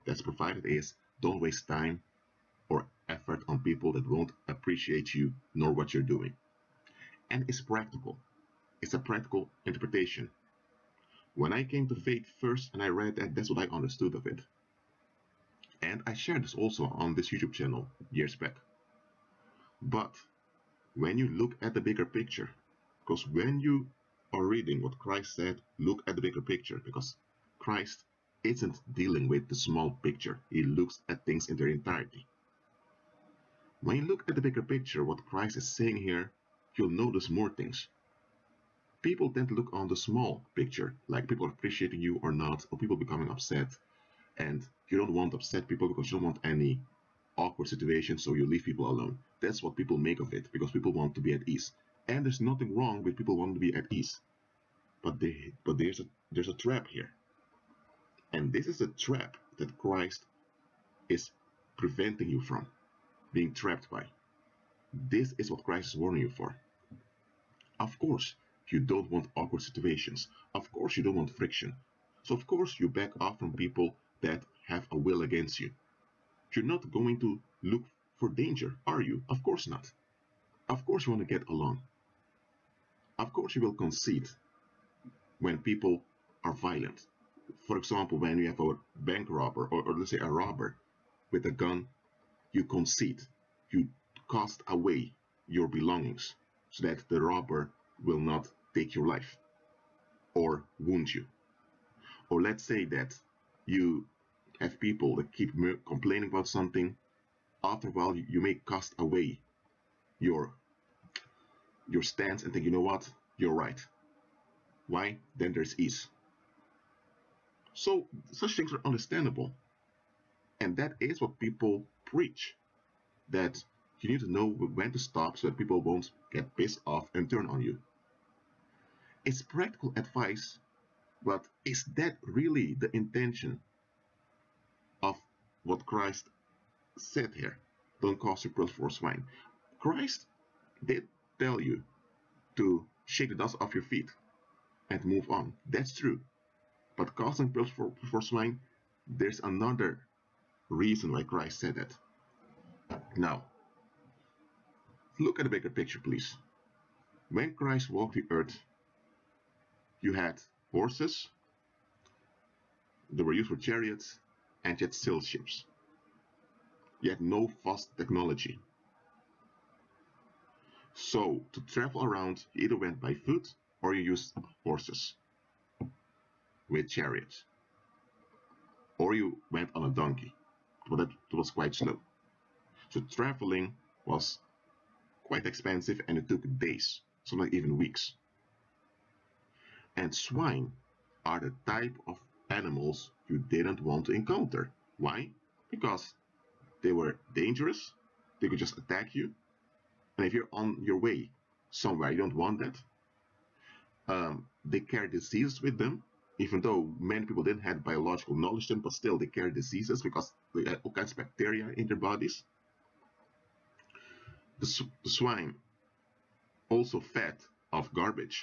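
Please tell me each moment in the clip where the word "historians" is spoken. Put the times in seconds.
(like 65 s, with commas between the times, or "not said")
not said.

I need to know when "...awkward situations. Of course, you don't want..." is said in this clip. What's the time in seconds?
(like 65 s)
69 s.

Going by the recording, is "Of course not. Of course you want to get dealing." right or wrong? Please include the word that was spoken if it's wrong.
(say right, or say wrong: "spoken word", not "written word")
wrong: "along", not "dealing".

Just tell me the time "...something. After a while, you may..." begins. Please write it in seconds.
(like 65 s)
106 s.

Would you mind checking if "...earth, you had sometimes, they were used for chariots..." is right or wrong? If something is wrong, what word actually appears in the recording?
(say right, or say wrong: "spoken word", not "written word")
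wrong: "horses", not "sometimes".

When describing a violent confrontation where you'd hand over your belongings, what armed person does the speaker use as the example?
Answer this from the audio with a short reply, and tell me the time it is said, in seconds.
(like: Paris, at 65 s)
bank robber, at 88 s.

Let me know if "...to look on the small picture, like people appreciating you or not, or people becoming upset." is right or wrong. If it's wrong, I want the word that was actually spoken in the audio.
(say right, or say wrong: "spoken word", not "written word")
right.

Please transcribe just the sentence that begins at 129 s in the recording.
It's practical advice, but is that really the intention of what Christ said here?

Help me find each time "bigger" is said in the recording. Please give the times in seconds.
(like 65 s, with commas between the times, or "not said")
21 s, 26 s, 34 s, 155 s.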